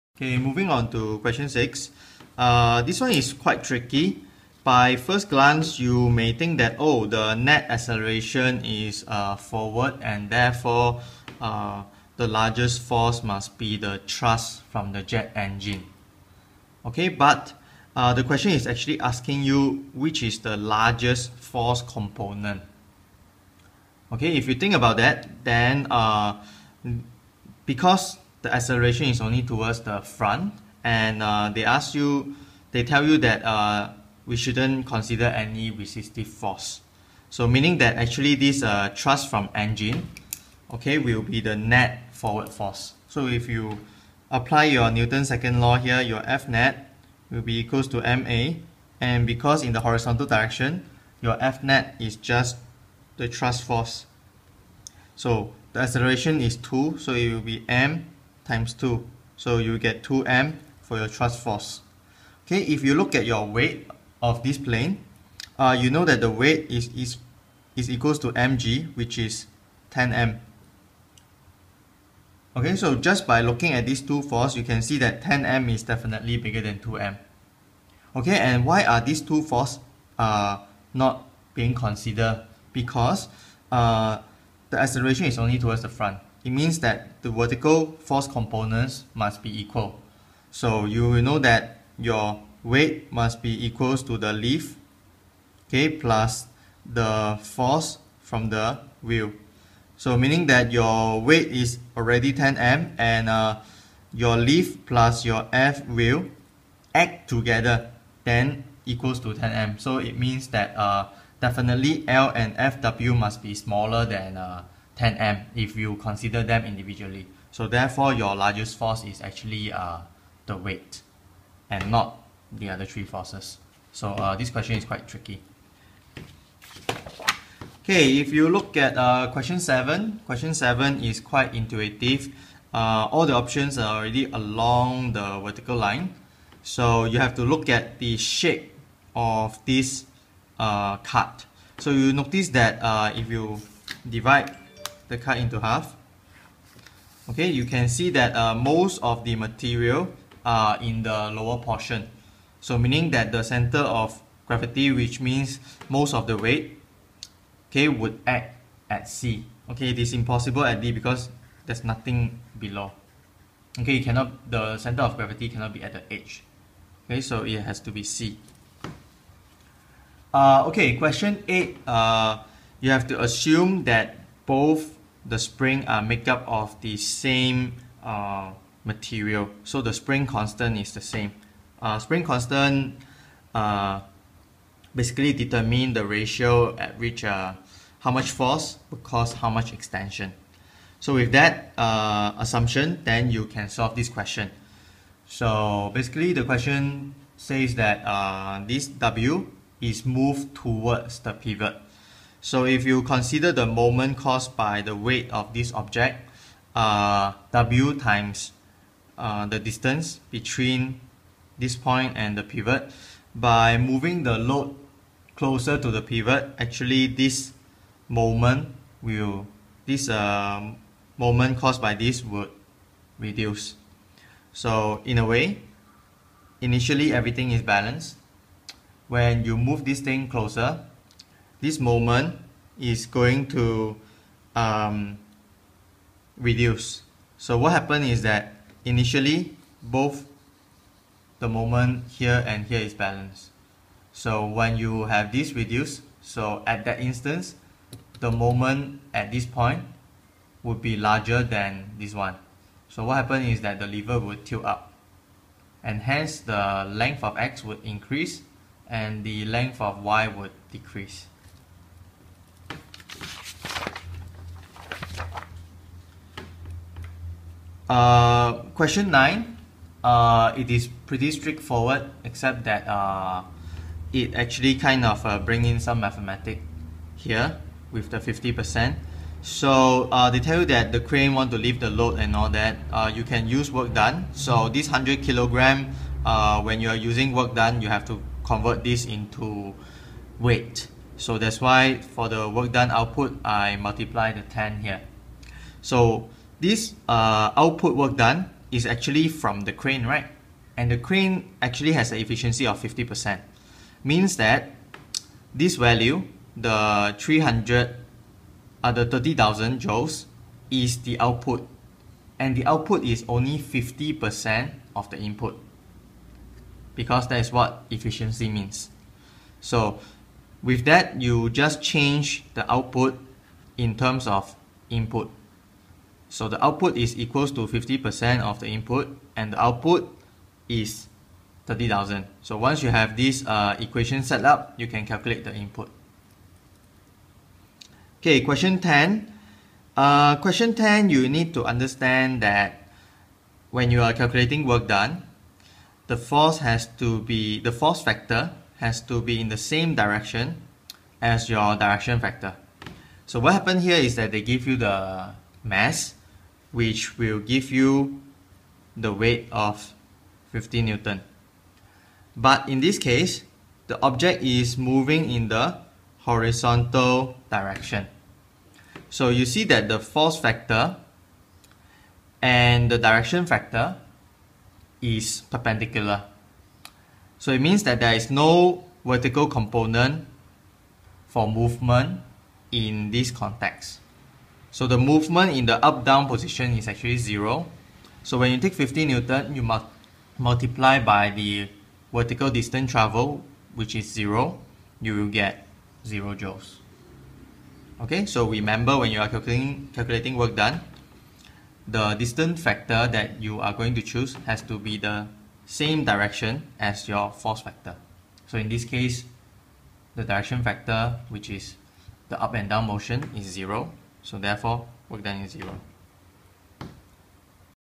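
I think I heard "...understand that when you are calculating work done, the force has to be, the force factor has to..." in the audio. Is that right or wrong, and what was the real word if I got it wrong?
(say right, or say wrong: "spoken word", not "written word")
right.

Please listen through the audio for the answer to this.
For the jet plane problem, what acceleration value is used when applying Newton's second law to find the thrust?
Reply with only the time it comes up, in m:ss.
0:55.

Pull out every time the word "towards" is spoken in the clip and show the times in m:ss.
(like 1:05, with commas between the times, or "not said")
0:29, 1:25, 3:20.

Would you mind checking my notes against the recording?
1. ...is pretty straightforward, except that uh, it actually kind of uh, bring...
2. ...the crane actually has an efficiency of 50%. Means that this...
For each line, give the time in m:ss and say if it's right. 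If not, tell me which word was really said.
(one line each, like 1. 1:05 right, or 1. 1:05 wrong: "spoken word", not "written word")
1. 4:30 right
2. 5:00 right.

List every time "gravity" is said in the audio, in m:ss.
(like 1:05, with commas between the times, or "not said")
2:34, 2:45.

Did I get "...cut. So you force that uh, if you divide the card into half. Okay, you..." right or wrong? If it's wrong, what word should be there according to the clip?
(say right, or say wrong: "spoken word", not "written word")
wrong: "notice", not "force".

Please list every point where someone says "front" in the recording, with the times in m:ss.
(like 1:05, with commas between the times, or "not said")
0:30, 1:25.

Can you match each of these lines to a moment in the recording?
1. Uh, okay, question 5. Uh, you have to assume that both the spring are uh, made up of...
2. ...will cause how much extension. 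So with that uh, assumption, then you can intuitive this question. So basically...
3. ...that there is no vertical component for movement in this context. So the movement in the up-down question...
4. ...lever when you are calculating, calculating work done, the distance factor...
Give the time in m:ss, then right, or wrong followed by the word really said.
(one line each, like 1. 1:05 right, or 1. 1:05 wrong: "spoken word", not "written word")
1. 2:50 wrong: "8", not "5"
2. 3:08 wrong: "solve", not "intuitive"
3. 6:17 wrong: "position", not "question"
4. 6:38 wrong: "remember", not "lever".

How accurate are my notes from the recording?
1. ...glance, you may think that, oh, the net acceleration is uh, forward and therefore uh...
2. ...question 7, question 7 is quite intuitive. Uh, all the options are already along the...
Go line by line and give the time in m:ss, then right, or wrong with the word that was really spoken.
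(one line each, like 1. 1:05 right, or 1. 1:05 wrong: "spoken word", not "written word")
1. 0:05 right
2. 2:09 right.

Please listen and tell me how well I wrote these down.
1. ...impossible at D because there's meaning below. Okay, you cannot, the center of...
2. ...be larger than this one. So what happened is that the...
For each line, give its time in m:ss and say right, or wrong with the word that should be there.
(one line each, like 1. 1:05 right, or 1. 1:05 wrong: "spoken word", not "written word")
1. 2:40 wrong: "nothing", not "meaning"
2. 4:10 right.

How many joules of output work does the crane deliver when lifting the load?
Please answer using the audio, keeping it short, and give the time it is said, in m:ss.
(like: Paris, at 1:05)
30,000 joules, at 5:09.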